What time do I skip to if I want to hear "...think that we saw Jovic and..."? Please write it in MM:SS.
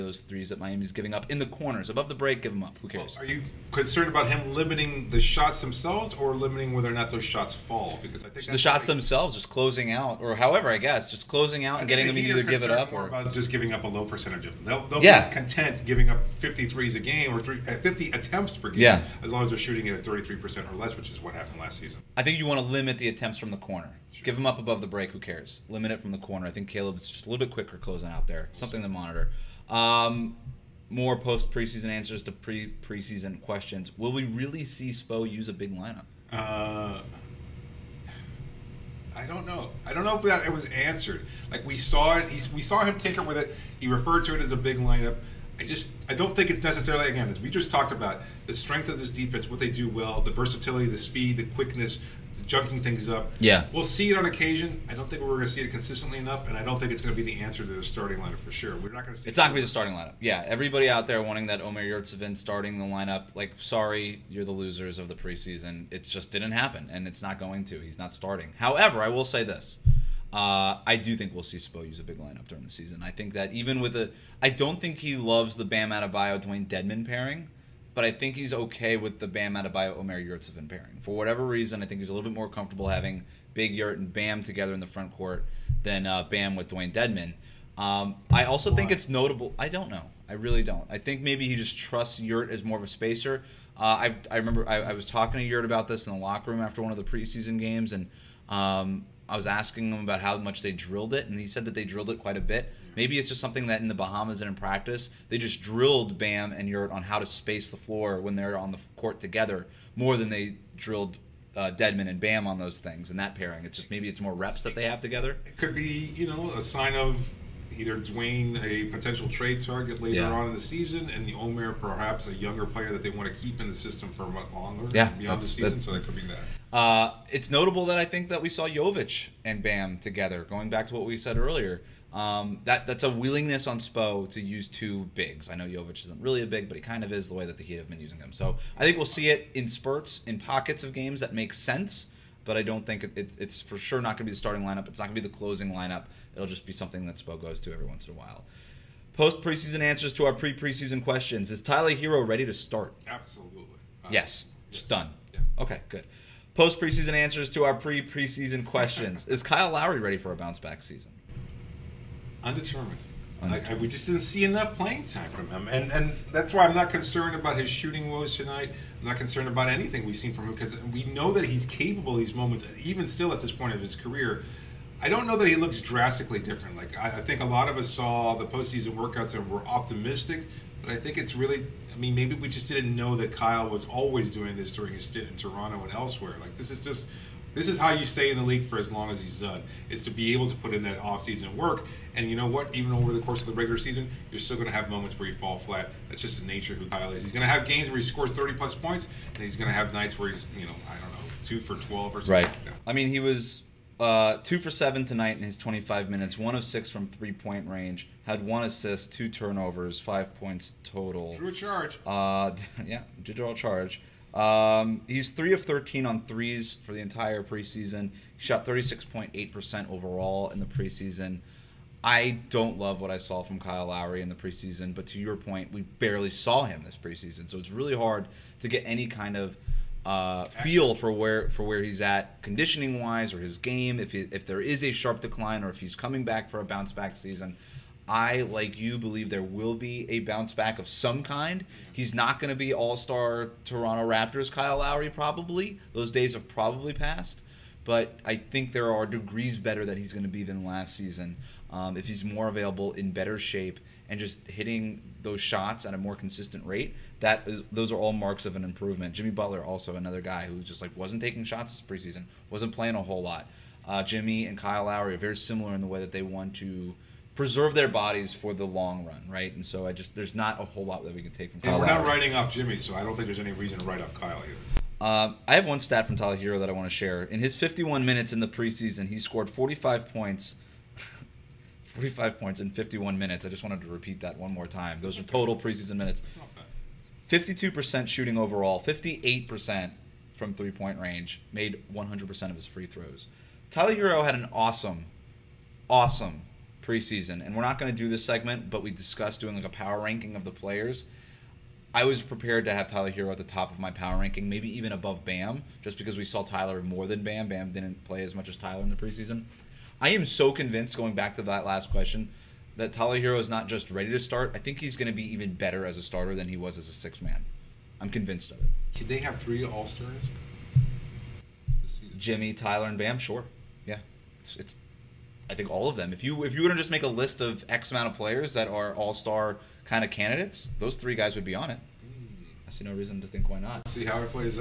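02:08.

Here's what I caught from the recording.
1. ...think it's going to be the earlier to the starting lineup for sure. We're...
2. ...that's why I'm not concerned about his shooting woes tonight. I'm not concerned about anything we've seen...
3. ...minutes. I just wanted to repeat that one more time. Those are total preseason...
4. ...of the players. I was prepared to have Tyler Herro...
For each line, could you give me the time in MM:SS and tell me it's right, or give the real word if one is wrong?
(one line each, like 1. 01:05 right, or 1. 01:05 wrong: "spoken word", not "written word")
1. 00:56 wrong: "answer", not "earlier"
2. 02:46 right
3. 04:43 right
4. 05:00 right.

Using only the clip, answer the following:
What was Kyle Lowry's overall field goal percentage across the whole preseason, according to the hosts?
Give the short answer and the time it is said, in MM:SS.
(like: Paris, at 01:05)
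36.8%, at 03:38.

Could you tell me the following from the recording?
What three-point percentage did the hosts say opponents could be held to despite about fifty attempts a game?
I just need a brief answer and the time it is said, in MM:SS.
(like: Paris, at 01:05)
33 percent, at 00:20.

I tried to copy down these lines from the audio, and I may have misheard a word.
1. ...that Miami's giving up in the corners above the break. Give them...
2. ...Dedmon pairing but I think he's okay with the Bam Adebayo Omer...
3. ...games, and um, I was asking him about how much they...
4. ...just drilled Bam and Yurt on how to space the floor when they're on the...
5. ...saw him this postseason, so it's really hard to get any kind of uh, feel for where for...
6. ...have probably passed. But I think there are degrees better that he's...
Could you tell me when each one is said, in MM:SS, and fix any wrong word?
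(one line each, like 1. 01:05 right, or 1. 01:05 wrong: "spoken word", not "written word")
1. 00:00 right
2. 01:16 right
3. 01:37 right
4. 01:45 right
5. 03:46 wrong: "preseason", not "postseason"
6. 04:06 right.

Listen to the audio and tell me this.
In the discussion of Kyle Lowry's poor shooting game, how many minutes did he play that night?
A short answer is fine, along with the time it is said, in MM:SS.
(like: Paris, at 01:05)
25, at 03:25.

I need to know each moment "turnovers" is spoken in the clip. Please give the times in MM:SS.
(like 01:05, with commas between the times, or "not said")
03:29.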